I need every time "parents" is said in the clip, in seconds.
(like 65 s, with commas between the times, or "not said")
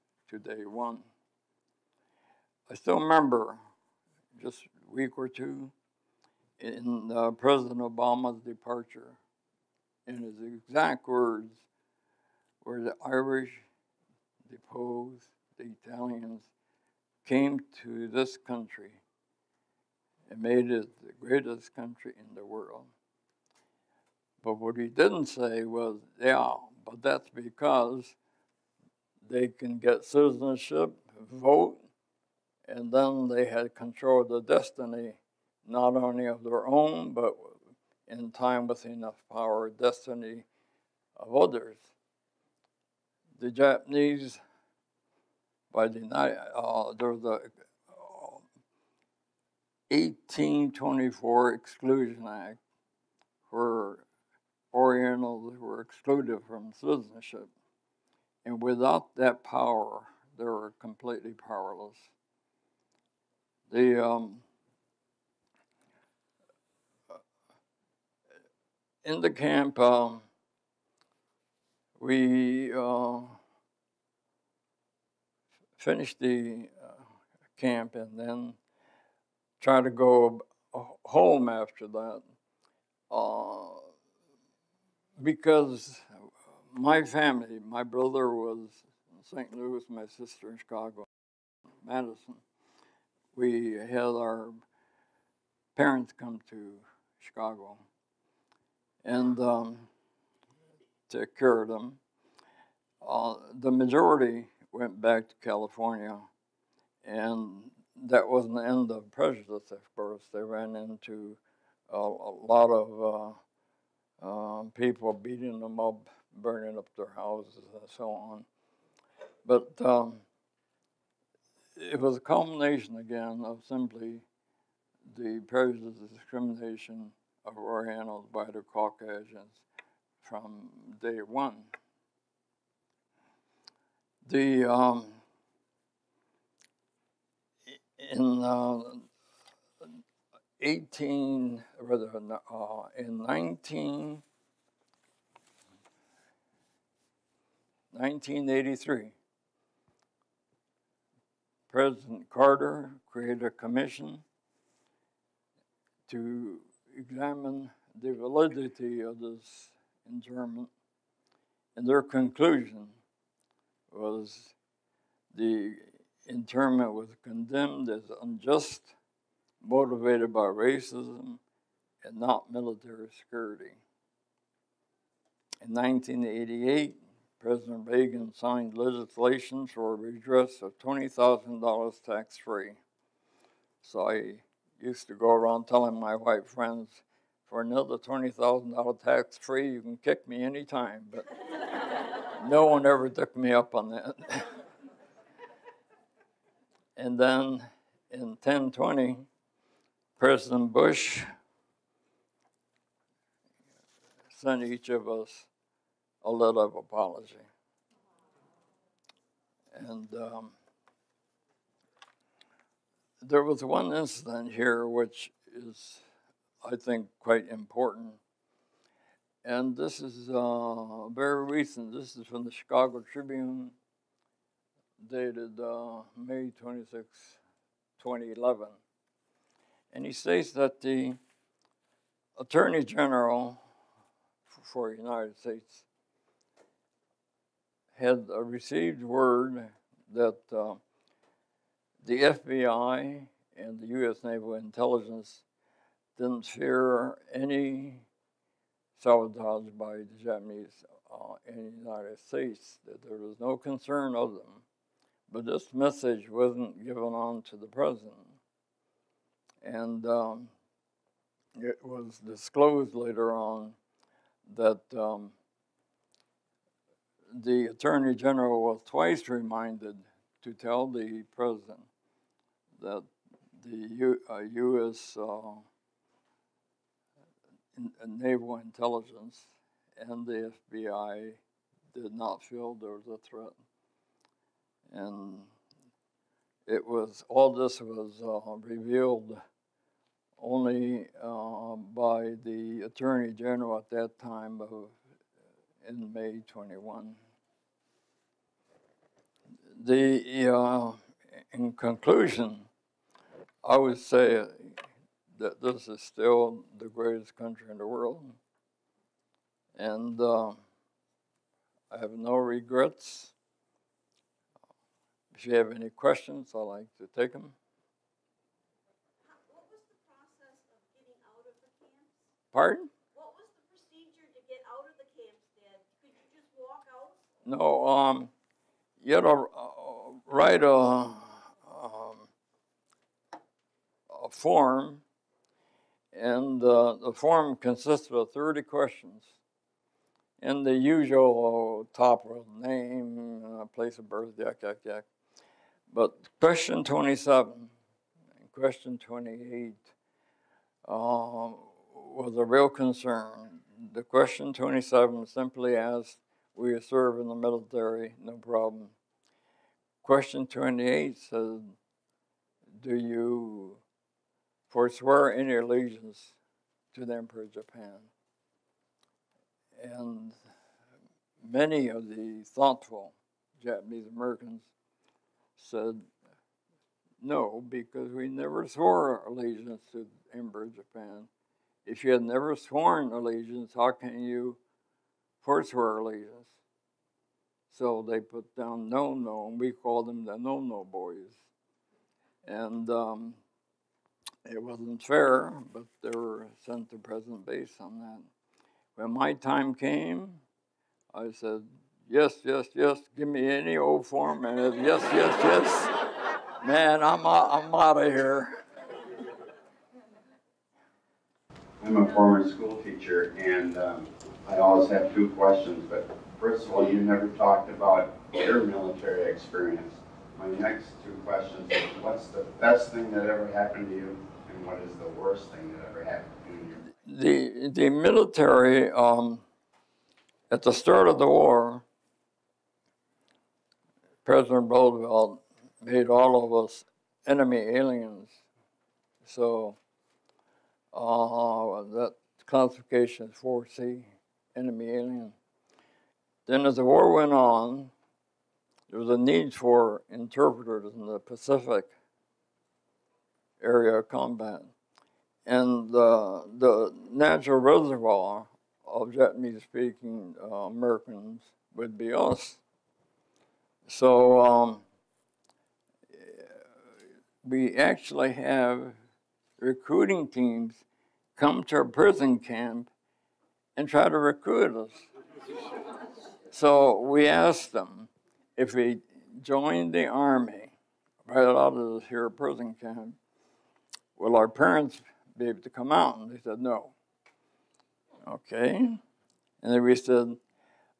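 95 s, 484 s.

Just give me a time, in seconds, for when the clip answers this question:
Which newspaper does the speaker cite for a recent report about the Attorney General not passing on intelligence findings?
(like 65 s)
222 s.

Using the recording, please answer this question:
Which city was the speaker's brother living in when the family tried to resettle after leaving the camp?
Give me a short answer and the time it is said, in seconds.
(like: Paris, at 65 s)
St. Louis, at 89 s.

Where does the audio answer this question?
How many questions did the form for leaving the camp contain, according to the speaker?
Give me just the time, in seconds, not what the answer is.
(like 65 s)
338 s.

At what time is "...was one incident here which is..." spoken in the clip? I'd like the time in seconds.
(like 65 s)
213 s.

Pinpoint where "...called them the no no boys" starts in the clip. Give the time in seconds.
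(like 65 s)
389 s.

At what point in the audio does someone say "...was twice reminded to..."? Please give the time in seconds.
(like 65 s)
268 s.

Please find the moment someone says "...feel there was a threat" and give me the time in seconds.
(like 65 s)
282 s.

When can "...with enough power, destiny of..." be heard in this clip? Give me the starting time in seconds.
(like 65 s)
38 s.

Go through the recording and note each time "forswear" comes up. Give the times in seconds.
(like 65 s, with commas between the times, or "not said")
364 s, 385 s.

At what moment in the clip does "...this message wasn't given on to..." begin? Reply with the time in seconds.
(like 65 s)
255 s.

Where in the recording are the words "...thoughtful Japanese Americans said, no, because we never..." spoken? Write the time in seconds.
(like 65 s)
372 s.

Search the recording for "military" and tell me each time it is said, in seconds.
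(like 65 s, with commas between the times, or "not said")
172 s, 357 s, 418 s, 427 s.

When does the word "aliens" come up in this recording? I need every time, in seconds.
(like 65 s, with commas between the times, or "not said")
437 s, 444 s.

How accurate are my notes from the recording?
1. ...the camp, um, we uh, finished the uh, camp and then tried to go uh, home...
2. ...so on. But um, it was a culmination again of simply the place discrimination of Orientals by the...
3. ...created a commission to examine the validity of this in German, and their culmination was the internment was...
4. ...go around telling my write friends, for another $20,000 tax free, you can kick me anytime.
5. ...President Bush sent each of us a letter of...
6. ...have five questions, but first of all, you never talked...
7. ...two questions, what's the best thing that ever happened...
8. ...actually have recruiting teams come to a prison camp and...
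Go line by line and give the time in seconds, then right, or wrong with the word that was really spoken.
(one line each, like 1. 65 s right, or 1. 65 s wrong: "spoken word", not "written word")
1. 69 s right
2. 117 s wrong: "prejudice", not "place"
3. 153 s wrong: "conclusion", not "culmination"
4. 185 s wrong: "white", not "write"
5. 200 s right
6. 414 s wrong: "two", not "five"
7. 421 s right
8. 467 s right.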